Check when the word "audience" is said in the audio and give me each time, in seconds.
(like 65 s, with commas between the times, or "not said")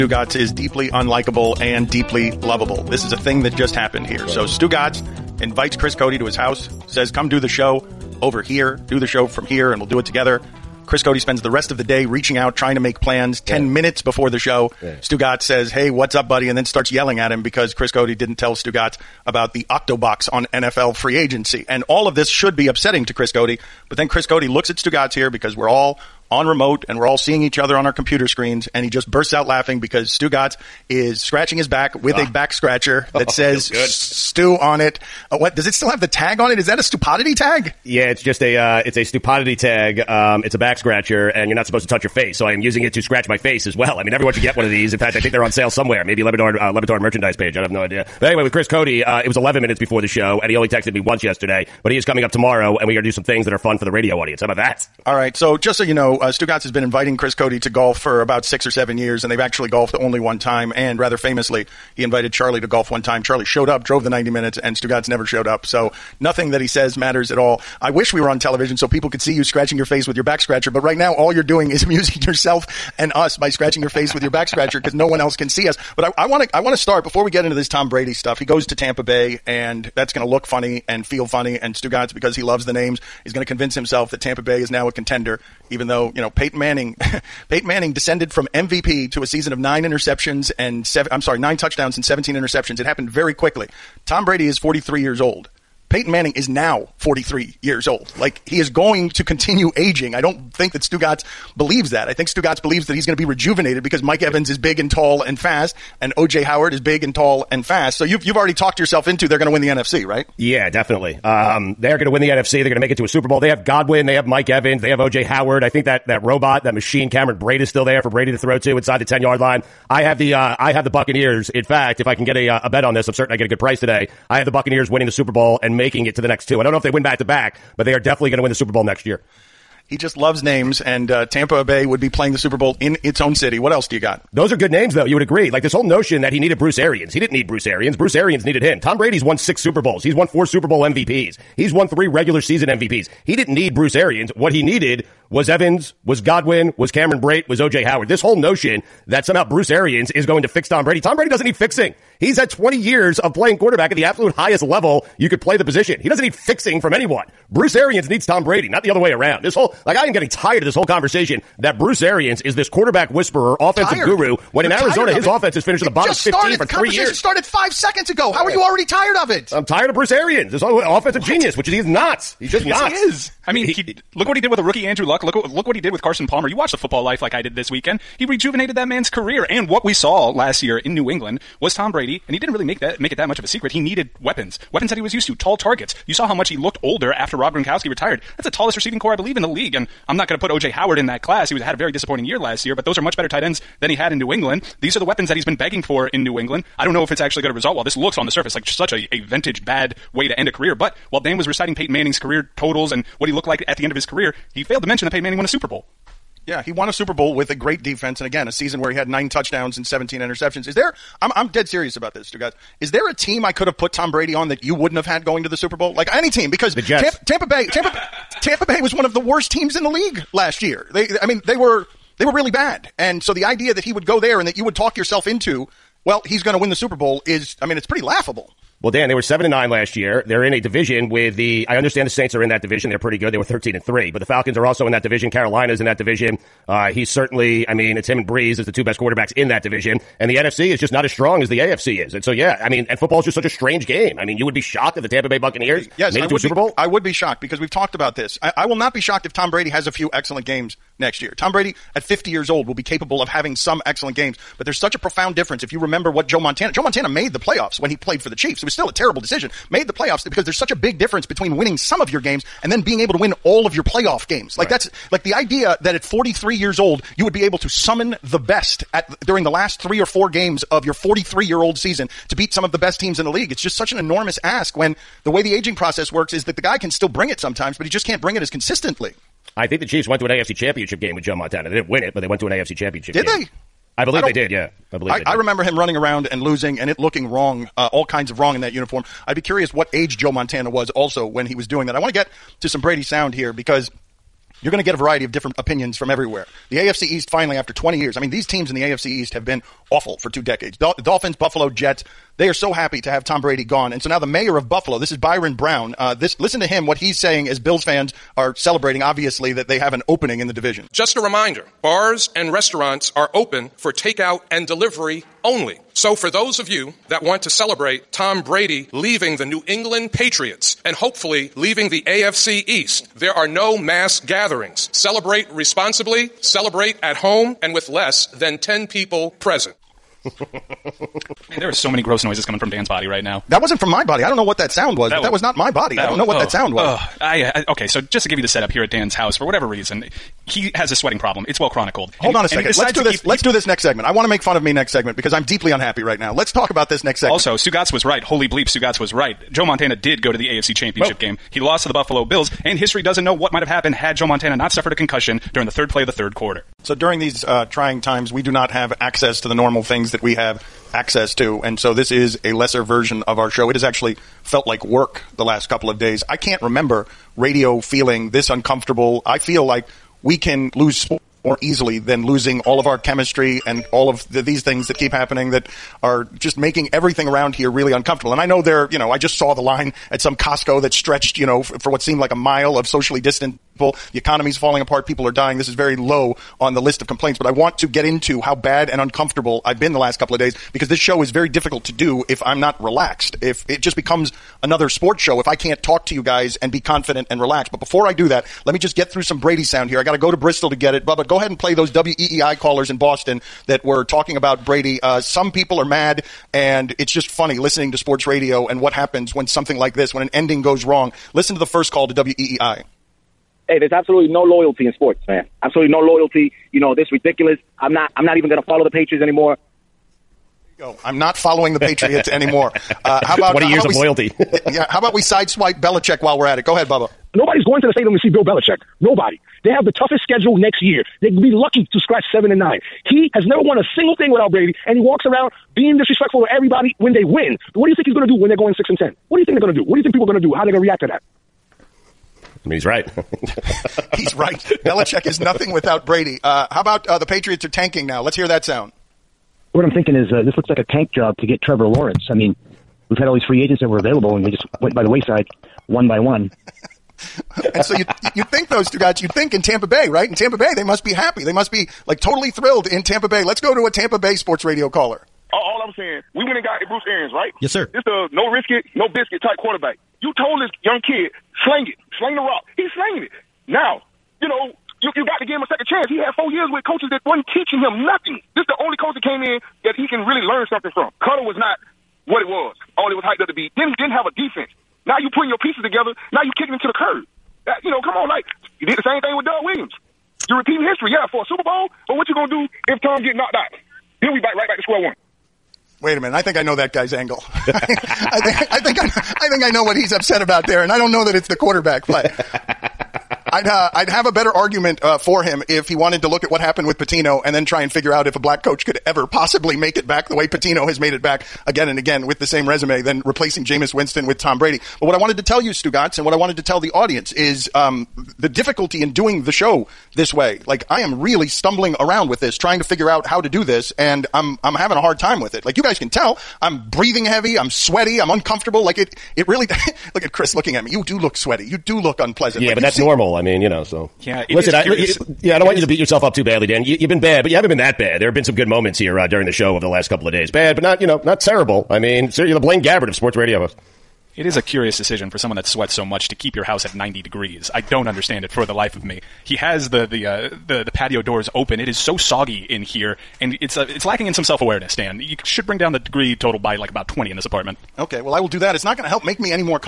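54 s, 516 s.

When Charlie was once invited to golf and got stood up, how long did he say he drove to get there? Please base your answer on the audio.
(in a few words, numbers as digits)
90 minutes.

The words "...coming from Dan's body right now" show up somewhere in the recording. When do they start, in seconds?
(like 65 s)
332 s.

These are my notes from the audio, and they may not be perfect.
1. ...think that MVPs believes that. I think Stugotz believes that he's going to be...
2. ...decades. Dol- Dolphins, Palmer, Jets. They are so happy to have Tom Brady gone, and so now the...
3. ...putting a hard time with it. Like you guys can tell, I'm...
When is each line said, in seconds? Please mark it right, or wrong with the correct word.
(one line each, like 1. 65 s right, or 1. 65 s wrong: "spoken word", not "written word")
1. 100 s wrong: "Stugotz", not "MVPs"
2. 300 s wrong: "Buffalo", not "Palmer"
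3. 524 s wrong: "having", not "putting".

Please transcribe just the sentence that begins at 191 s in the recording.
He was had a very disappointing year last year, but those are much better tight ends than he had in New England.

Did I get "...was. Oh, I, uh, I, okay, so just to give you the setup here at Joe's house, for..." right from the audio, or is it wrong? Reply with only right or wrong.
wrong.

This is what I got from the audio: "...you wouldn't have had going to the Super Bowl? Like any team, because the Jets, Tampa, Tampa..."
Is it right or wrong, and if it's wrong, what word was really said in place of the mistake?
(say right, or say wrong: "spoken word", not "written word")
right.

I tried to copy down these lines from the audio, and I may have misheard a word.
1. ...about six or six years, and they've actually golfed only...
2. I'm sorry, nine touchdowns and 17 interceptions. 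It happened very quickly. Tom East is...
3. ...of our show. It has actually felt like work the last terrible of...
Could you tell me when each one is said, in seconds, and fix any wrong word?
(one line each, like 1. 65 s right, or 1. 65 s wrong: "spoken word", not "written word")
1. 58 s wrong: "seven", not "six"
2. 91 s wrong: "Brady", not "East"
3. 363 s wrong: "couple", not "terrible".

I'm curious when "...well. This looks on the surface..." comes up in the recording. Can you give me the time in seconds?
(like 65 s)
197 s.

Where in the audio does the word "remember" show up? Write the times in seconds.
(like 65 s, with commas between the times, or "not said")
255 s, 285 s, 366 s.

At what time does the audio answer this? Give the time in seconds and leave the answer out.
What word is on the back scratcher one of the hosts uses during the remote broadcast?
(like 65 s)
33 s.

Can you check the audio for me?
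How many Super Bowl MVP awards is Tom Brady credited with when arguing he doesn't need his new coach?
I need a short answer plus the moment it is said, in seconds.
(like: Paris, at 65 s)
4, at 140 s.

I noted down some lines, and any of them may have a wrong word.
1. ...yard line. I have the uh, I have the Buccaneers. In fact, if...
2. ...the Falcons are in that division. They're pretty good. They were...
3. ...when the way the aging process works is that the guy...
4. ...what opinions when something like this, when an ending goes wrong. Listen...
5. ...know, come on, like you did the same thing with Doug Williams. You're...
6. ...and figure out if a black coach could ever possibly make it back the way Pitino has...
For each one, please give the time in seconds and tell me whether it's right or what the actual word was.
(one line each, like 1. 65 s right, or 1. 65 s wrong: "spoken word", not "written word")
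1. 119 s right
2. 232 s wrong: "Saints", not "Falcons"
3. 274 s right
4. 408 s wrong: "happens", not "opinions"
5. 487 s right
6. 507 s right.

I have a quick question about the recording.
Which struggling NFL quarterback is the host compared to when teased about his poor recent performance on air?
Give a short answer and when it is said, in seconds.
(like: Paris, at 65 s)
Blaine Gabbert, at 542 s.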